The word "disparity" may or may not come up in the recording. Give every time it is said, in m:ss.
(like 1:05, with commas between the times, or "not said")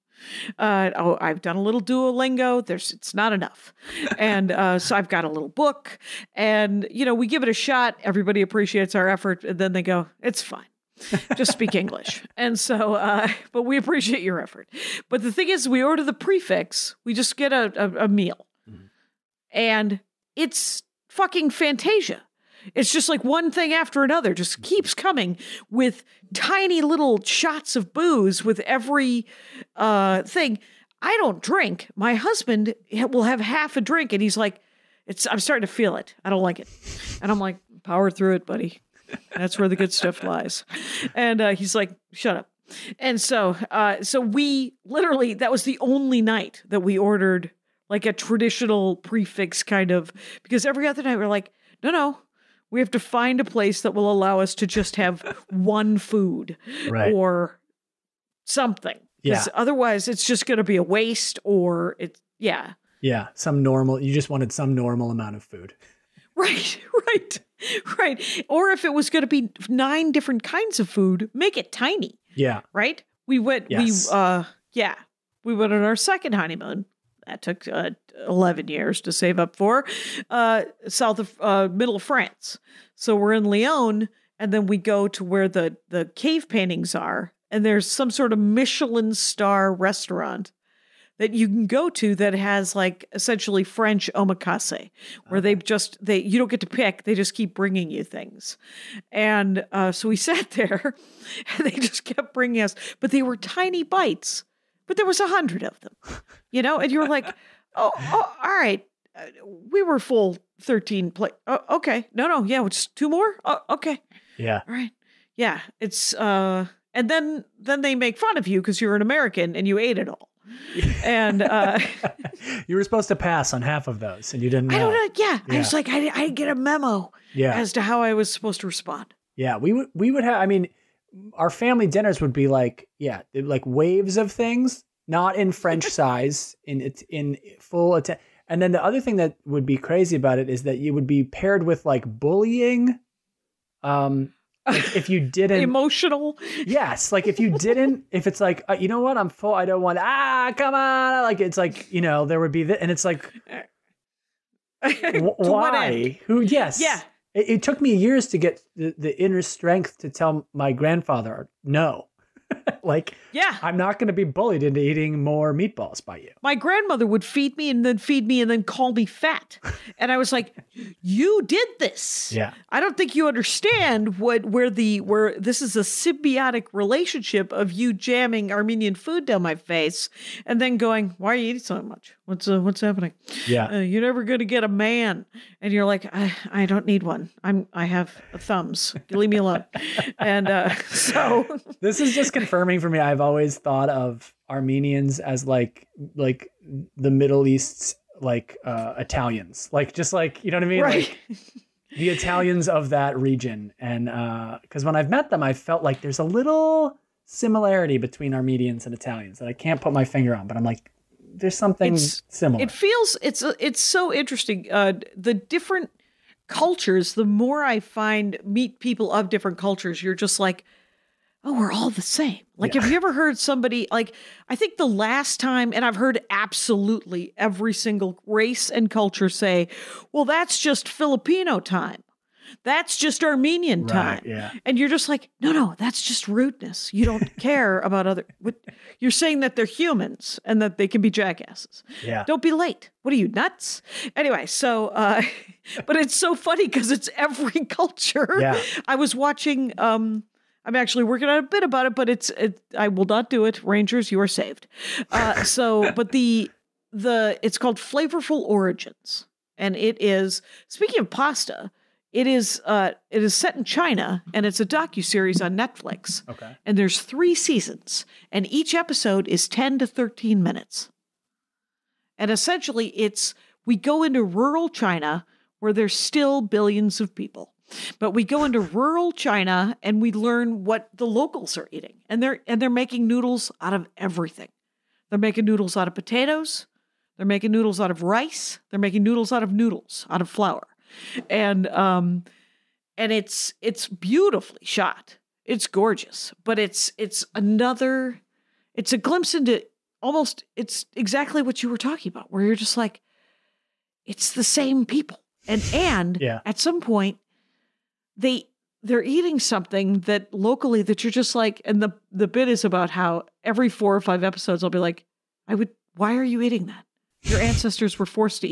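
not said.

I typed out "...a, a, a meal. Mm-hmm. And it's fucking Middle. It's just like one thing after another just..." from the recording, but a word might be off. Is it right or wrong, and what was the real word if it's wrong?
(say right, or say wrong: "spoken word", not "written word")
wrong: "Fantasia", not "Middle".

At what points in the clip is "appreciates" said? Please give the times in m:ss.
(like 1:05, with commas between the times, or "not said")
0:08, 0:13.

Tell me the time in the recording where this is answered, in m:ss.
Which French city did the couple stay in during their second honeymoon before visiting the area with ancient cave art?
1:23.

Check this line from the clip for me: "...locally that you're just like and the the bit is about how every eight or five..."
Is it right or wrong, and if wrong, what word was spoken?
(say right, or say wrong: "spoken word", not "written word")
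wrong: "four", not "eight".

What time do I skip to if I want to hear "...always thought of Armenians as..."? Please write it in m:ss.
3:13.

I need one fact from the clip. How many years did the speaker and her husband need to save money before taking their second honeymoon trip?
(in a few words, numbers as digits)
11.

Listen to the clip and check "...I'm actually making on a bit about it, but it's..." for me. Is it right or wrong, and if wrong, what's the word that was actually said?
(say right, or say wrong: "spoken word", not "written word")
wrong: "working", not "making".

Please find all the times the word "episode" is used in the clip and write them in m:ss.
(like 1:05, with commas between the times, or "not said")
4:28, 5:14.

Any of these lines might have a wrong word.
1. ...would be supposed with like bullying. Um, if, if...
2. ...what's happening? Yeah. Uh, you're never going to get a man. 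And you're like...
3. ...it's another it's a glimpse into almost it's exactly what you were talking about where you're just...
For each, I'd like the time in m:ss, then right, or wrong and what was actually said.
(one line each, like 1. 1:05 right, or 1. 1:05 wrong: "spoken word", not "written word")
1. 2:20 wrong: "paired", not "supposed"
2. 3:02 right
3. 4:56 right.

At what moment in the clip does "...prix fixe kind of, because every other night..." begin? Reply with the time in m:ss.
0:48.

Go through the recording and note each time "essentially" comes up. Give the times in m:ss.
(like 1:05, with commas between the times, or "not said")
1:33, 4:32.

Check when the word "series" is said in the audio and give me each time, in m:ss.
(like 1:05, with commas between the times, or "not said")
4:25.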